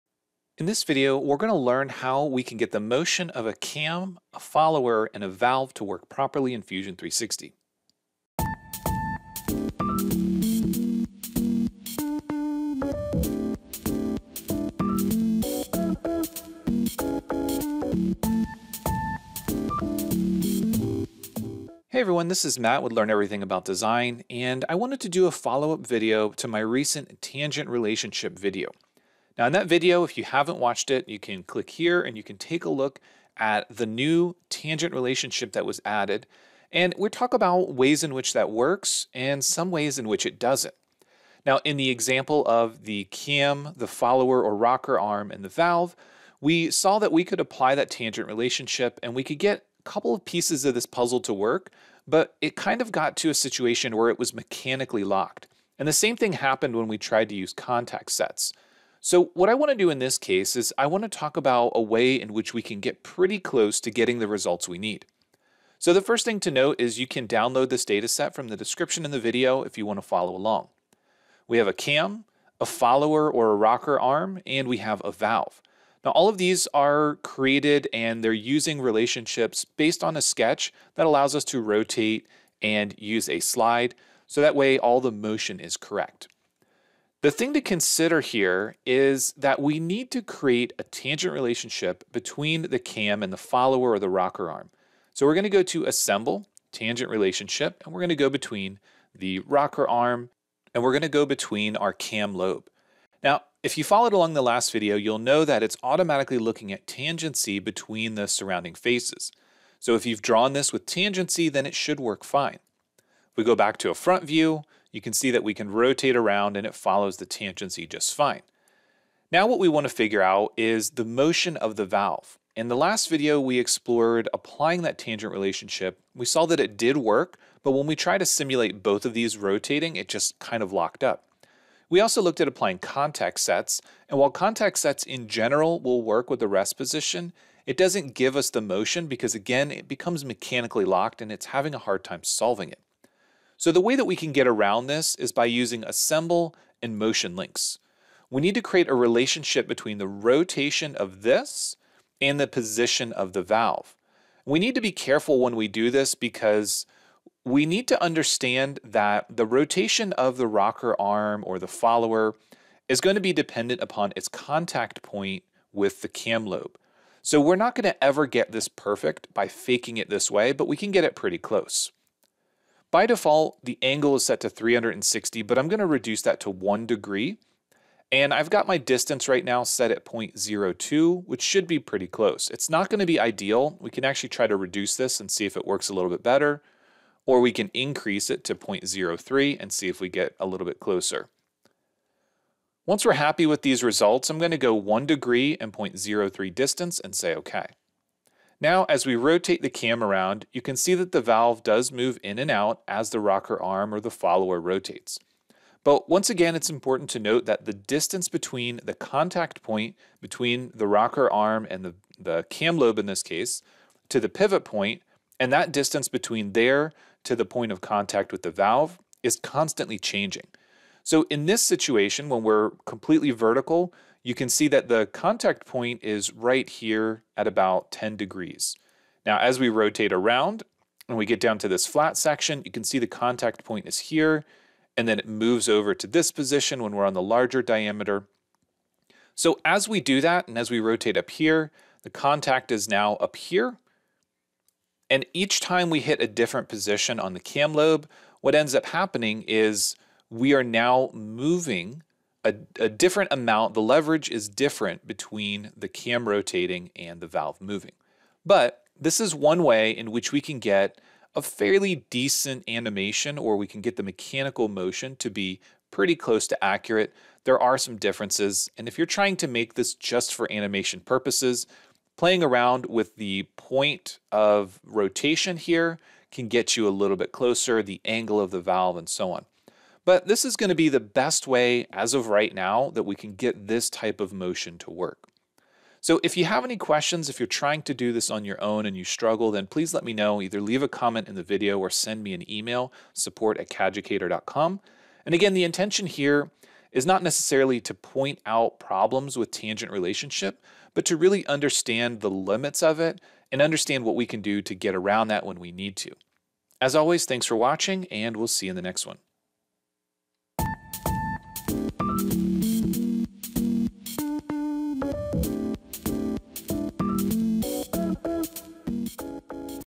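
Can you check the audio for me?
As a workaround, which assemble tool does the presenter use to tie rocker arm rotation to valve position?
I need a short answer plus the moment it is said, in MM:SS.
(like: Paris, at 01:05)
Motion links, at 02:26.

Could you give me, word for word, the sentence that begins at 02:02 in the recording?
In the last video, we explored applying that tangent relationship.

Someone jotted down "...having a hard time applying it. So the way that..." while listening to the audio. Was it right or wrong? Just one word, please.
wrong.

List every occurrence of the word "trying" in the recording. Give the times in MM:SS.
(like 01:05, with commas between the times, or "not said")
04:29, 04:47.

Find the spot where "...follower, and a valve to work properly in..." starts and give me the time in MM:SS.
00:04.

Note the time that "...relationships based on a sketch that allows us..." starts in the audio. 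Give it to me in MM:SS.
01:18.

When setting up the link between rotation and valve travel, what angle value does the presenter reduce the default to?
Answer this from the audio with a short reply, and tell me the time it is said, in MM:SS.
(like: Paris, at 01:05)
1 degree, at 02:56.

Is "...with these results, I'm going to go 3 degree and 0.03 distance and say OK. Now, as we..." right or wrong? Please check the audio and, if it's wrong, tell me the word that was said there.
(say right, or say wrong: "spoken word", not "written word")
wrong: "1", not "3".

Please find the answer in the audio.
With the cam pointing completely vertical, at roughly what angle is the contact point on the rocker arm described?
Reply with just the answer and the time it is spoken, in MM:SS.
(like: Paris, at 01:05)
About 10 degrees, at 03:47.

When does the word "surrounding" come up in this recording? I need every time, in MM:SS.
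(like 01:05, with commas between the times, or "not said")
01:48.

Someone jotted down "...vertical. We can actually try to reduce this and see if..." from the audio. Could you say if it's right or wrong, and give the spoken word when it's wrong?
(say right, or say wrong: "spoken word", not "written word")
wrong: "ideal", not "vertical".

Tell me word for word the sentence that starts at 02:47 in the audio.
So we're not going to ever get this perfect by faking it this way, but we can get it pretty close.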